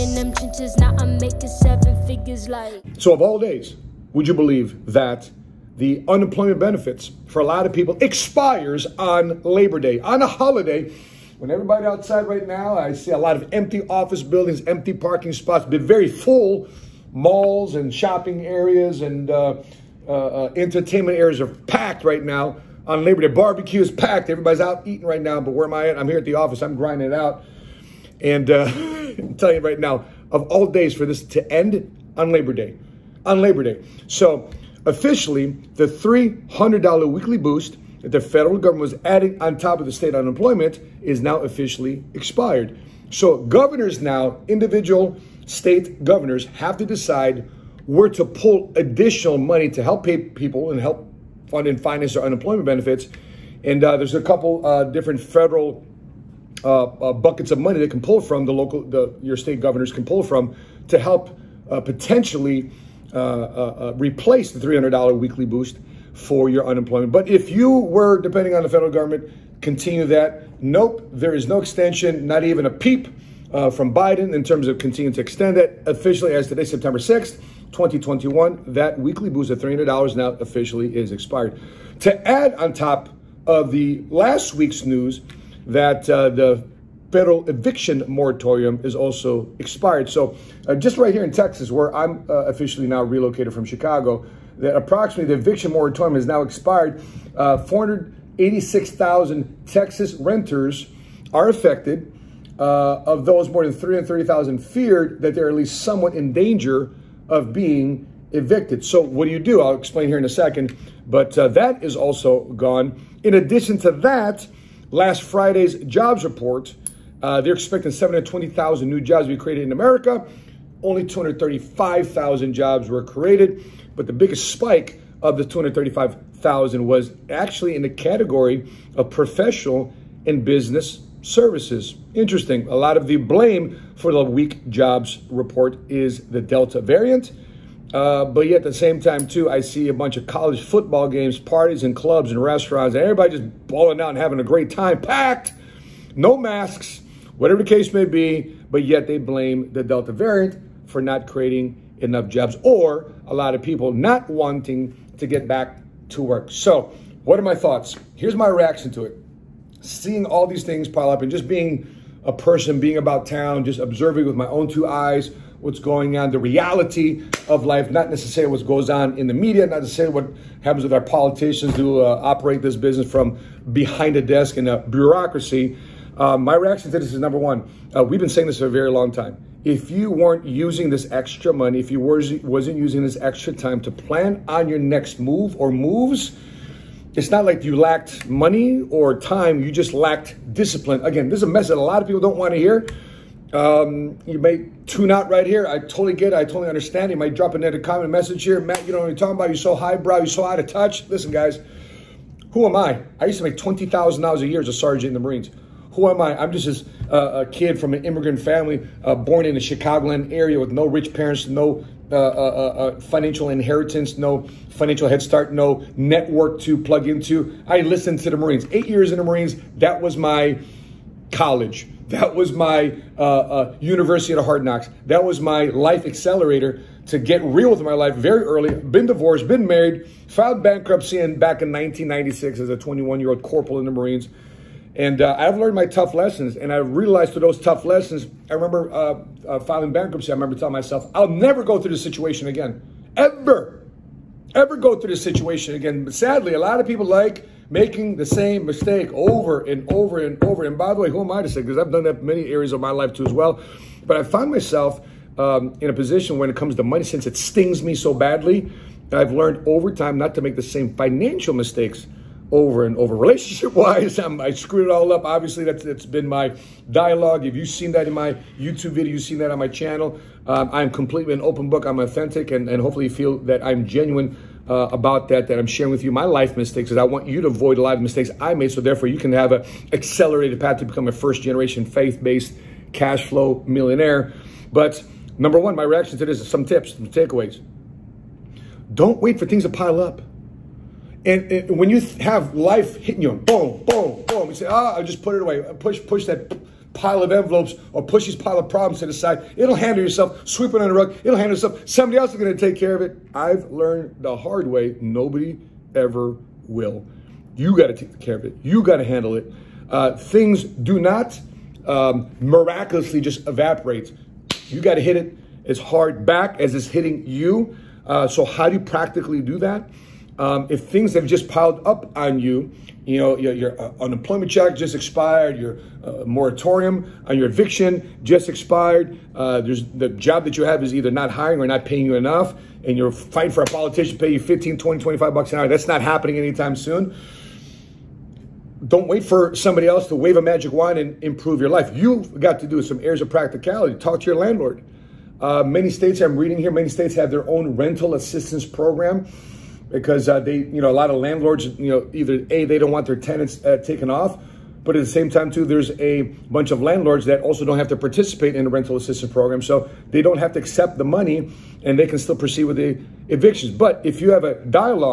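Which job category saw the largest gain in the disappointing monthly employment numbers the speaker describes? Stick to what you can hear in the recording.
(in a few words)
professional and business services.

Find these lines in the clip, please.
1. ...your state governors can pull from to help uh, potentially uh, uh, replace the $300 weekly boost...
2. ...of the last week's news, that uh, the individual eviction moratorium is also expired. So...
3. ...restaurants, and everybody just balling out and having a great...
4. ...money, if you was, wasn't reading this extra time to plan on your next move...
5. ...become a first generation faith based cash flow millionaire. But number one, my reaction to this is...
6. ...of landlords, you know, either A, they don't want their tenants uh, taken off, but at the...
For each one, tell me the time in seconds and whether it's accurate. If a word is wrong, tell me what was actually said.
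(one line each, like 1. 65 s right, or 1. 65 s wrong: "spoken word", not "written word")
1. 59 s right
2. 83 s wrong: "federal", not "individual"
3. 142 s right
4. 181 s wrong: "using", not "reading"
5. 280 s right
6. 351 s right.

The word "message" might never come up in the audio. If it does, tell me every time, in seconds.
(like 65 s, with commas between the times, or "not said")
191 s, 198 s.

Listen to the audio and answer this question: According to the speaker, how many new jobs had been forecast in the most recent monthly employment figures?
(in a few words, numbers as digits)
720,000.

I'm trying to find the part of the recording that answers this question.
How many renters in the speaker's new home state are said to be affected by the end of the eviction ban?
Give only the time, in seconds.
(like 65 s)
97 s.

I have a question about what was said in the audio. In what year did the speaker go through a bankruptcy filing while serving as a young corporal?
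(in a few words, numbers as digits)
1996.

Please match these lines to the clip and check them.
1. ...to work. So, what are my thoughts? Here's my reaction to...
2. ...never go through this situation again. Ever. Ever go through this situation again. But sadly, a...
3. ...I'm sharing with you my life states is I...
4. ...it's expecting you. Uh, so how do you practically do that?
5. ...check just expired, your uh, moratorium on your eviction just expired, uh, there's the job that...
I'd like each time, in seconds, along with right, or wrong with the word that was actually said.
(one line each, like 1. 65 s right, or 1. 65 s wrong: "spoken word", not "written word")
1. 156 s right
2. 241 s right
3. 275 s wrong: "mistakes", not "states"
4. 316 s wrong: "hitting", not "expecting"
5. 324 s right.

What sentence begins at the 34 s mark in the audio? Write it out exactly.
So officially, the $300 weekly boost that the federal government was adding on top of the state unemployment is now officially expired.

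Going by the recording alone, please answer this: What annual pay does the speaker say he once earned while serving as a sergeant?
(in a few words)
$20,000.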